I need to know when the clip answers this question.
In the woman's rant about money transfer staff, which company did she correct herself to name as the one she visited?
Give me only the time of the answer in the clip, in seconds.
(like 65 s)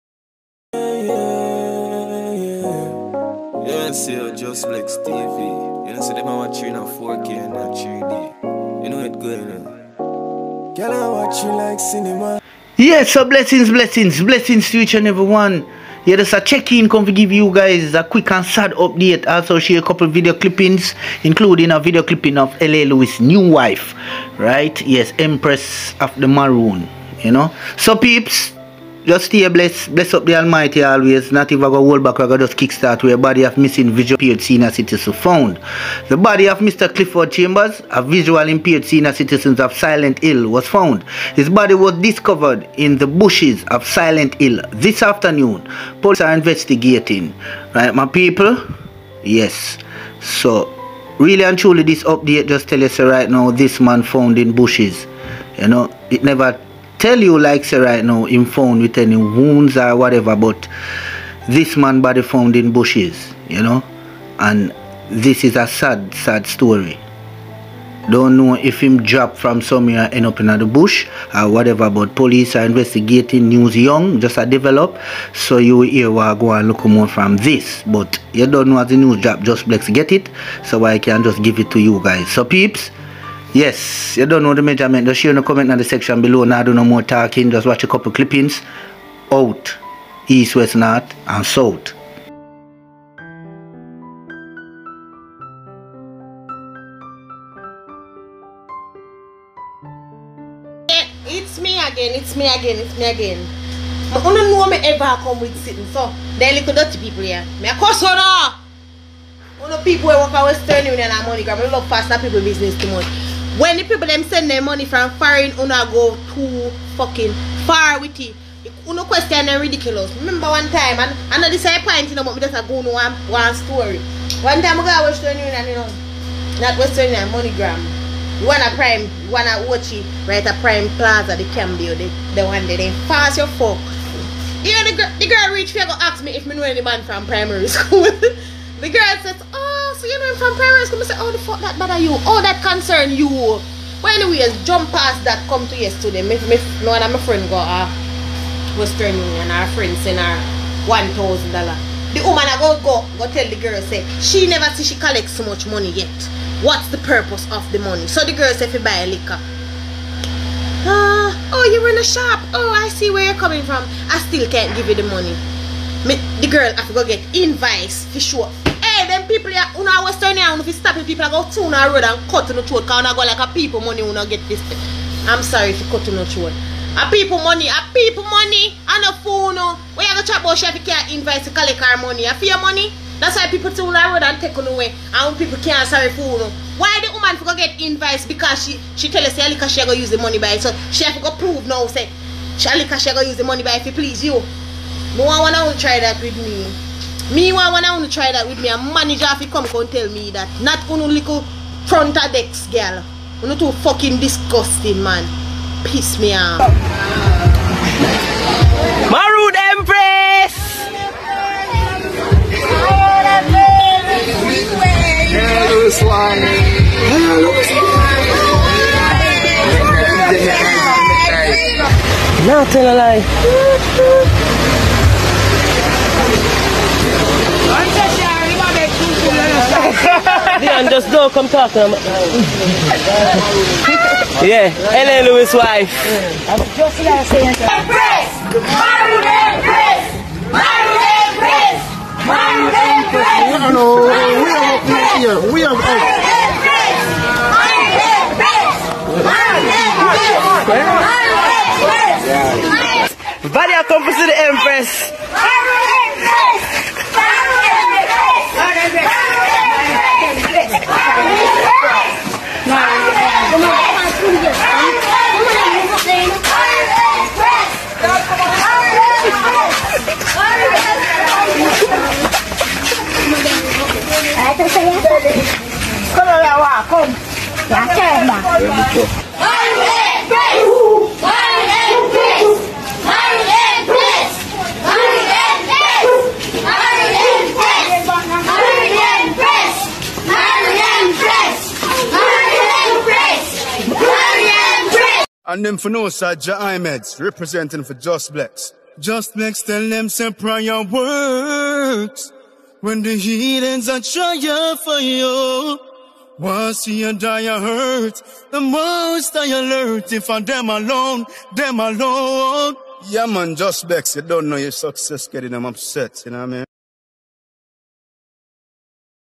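127 s.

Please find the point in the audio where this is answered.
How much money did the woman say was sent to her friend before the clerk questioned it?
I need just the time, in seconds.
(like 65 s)
150 s.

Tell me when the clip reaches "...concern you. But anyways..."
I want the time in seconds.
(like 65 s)
142 s.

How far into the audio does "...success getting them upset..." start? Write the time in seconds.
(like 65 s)
314 s.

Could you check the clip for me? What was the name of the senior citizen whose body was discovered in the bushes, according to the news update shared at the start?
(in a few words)
Clifford Chambers.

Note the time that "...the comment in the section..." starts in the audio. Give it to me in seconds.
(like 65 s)
85 s.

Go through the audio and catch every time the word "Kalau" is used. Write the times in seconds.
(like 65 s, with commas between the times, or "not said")
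276 s.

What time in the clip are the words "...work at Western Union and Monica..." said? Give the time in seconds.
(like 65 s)
110 s.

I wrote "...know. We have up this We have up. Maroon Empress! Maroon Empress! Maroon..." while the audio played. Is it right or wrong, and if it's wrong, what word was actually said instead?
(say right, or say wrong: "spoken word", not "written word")
right.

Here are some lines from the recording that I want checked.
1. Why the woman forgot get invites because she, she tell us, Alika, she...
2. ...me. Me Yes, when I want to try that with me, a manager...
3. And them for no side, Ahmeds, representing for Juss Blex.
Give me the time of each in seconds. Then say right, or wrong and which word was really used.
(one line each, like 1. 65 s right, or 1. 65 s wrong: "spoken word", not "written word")
1. 186 s right
2. 196 s wrong: "Meanwhile", not "Yes"
3. 295 s right.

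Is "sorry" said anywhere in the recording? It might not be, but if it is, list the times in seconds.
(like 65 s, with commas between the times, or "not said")
175 s, 185 s.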